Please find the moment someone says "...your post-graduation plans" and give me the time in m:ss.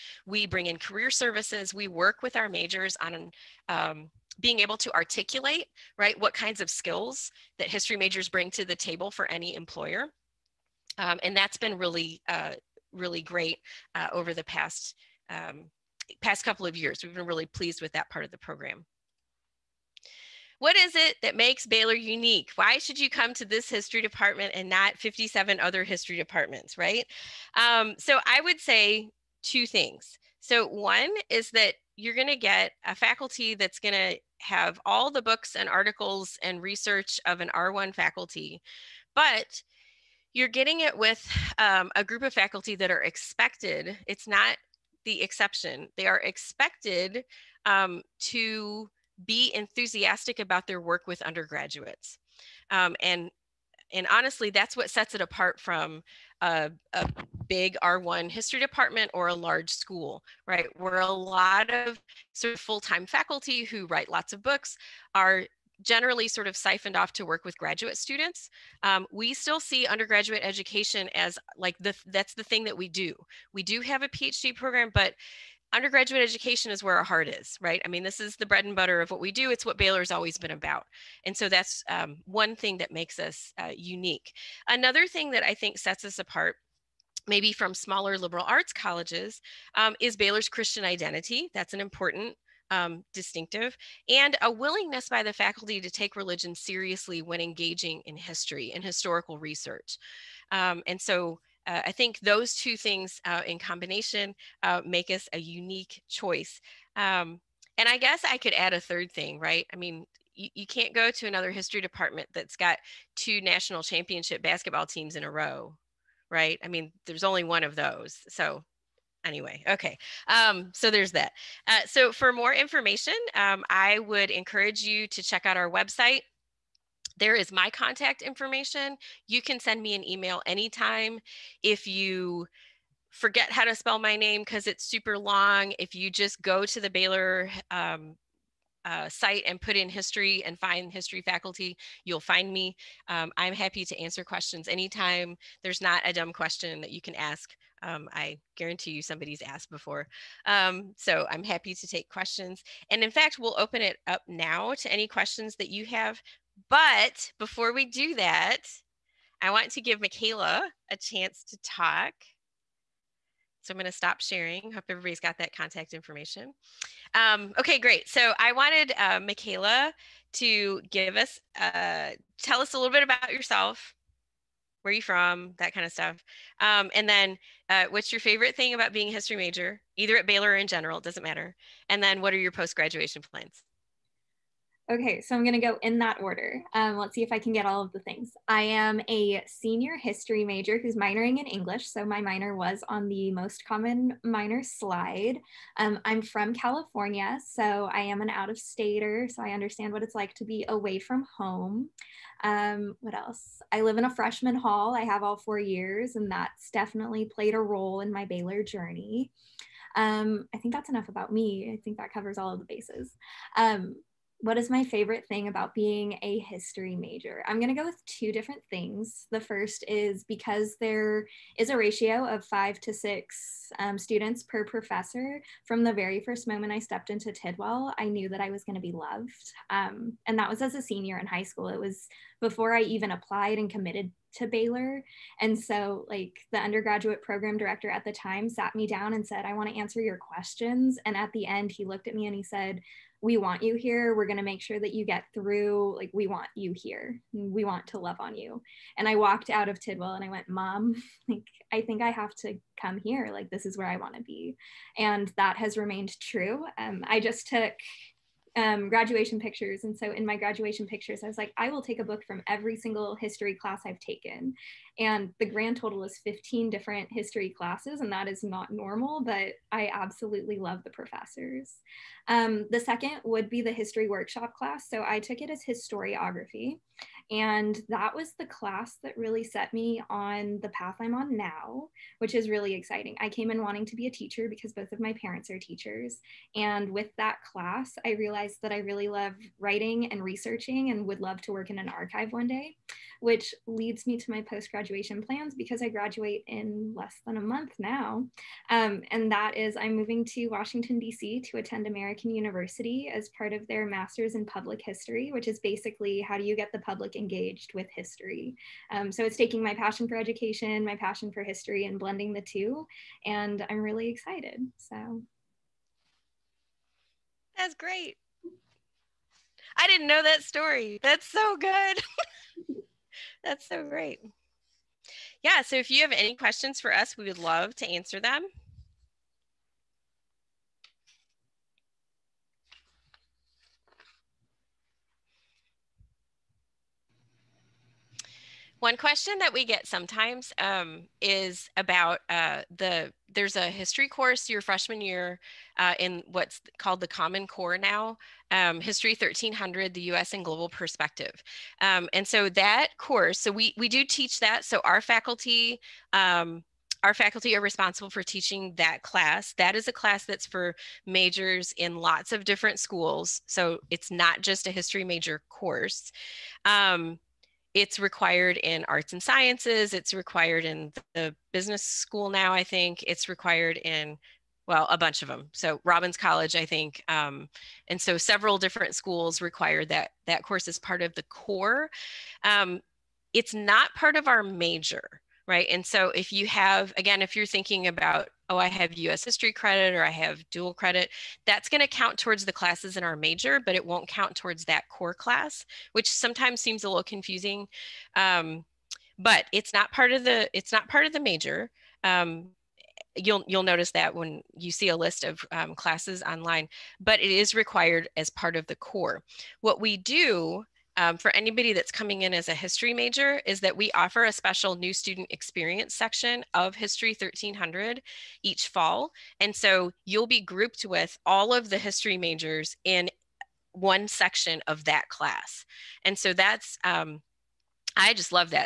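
3:02.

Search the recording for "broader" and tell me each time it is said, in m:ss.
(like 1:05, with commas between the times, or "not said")
not said.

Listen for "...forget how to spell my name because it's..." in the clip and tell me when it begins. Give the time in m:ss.
2:13.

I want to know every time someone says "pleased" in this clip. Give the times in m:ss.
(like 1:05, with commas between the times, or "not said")
0:17.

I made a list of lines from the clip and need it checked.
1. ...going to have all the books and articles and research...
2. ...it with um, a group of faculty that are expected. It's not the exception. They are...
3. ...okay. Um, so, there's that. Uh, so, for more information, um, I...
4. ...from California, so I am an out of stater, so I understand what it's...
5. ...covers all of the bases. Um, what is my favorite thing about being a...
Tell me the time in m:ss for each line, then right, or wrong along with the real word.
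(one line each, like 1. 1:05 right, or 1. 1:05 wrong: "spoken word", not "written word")
1. 0:33 right
2. 0:40 right
3. 1:59 right
4. 3:16 right
5. 3:32 right.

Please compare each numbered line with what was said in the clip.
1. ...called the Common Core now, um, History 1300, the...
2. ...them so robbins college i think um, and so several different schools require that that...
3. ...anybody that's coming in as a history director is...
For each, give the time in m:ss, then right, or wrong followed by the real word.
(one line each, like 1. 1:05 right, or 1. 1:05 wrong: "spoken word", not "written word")
1. 5:46 right
2. 6:15 right
3. 6:51 wrong: "major", not "director".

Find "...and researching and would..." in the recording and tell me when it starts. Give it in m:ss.
4:50.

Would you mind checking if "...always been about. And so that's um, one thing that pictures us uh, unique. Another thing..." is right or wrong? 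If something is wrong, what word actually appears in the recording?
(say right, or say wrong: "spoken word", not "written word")
wrong: "makes", not "pictures".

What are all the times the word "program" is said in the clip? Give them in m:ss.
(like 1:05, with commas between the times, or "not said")
0:18, 1:14, 3:57.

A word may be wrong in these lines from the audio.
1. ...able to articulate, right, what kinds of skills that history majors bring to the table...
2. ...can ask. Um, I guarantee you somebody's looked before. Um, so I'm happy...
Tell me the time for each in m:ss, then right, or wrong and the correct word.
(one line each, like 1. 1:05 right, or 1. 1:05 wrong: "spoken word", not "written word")
1. 0:04 right
2. 2:27 wrong: "asked", not "looked".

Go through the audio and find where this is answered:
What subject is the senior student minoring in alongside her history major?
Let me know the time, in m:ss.
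3:11.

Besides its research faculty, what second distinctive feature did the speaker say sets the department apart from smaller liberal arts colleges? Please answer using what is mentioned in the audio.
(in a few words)
Christian identity.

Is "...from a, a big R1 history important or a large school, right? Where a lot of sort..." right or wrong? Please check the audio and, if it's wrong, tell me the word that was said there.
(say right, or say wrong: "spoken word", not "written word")
wrong: "department", not "important".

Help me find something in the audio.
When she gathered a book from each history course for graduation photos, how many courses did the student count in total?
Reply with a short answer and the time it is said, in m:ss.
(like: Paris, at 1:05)
15, at 4:26.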